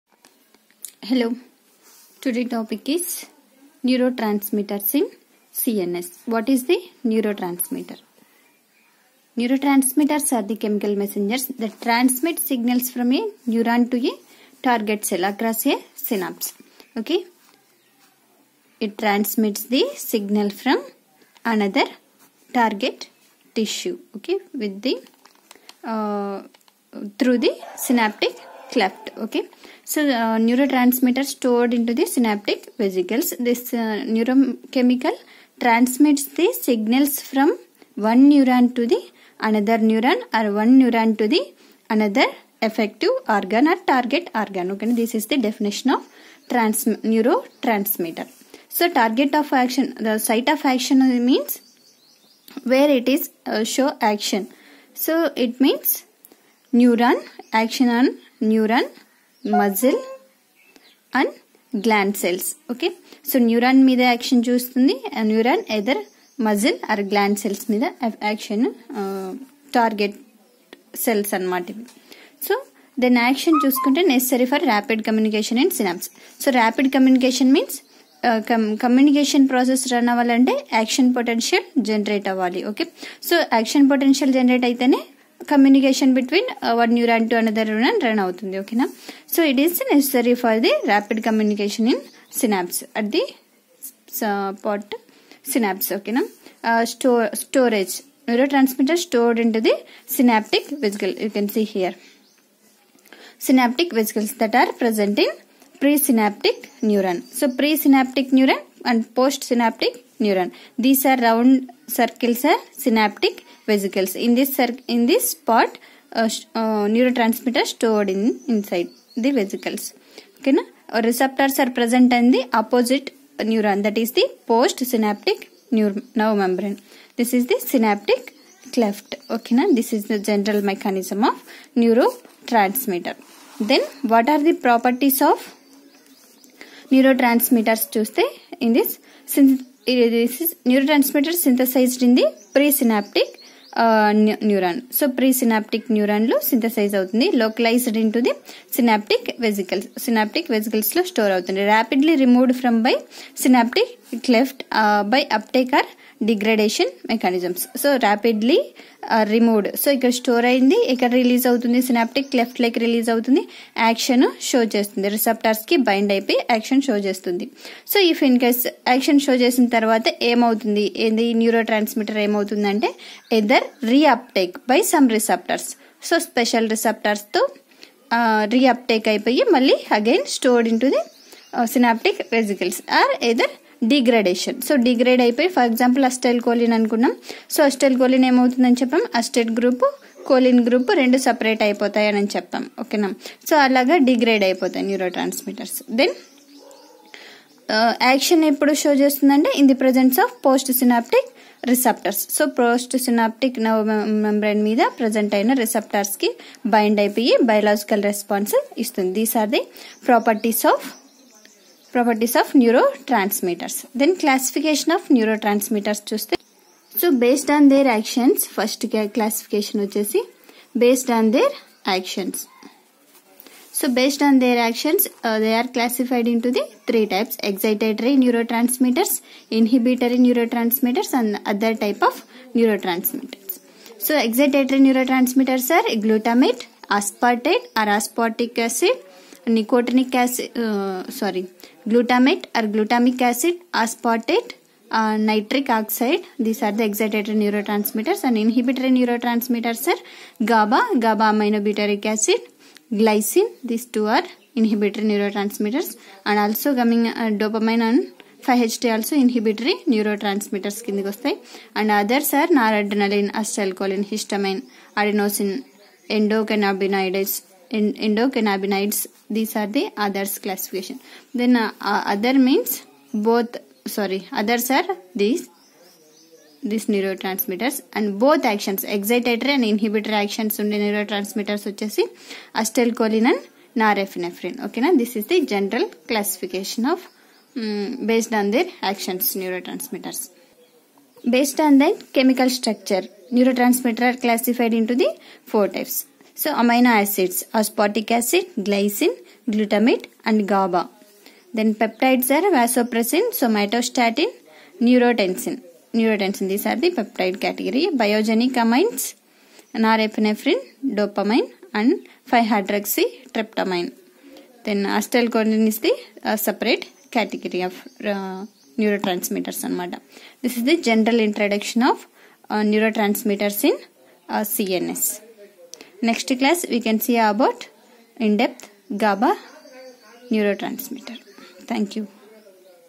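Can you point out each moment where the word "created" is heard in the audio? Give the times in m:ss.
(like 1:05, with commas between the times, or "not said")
not said.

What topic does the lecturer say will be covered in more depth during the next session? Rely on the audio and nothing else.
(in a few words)
GABA neurotransmitter.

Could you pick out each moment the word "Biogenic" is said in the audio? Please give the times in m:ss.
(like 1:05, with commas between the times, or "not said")
5:07.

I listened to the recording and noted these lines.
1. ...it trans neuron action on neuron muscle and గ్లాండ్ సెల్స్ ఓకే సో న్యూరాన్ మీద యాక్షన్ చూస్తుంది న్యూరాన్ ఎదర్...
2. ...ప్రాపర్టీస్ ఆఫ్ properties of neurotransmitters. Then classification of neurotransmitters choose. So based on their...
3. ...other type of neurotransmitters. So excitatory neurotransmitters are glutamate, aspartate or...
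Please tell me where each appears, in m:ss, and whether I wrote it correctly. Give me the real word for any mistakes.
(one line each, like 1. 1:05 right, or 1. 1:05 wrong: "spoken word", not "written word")
1. 0:55 wrong: "means", not "trans"
2. 3:30 right
3. 3:51 right.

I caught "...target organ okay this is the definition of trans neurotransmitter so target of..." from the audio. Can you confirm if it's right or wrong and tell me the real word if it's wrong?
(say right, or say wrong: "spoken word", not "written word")
right.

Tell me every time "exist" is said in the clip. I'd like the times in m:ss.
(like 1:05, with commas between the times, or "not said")
not said.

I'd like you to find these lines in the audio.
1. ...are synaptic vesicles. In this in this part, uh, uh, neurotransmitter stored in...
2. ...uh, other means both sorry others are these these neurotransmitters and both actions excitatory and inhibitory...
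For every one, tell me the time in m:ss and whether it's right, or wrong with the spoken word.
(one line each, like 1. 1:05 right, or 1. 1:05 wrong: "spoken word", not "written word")
1. 1:52 right
2. 4:31 right.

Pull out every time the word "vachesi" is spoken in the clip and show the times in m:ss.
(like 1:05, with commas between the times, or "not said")
4:41.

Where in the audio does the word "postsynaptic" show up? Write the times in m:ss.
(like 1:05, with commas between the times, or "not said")
1:49, 2:04.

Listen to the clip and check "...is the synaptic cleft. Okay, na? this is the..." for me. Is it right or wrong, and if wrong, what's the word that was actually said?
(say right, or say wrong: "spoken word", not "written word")
right.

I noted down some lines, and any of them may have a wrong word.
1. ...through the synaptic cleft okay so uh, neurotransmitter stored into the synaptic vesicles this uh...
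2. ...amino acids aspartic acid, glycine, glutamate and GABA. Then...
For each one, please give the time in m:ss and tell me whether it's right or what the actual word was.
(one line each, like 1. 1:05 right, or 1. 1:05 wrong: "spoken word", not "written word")
1. 0:27 right
2. 4:56 right.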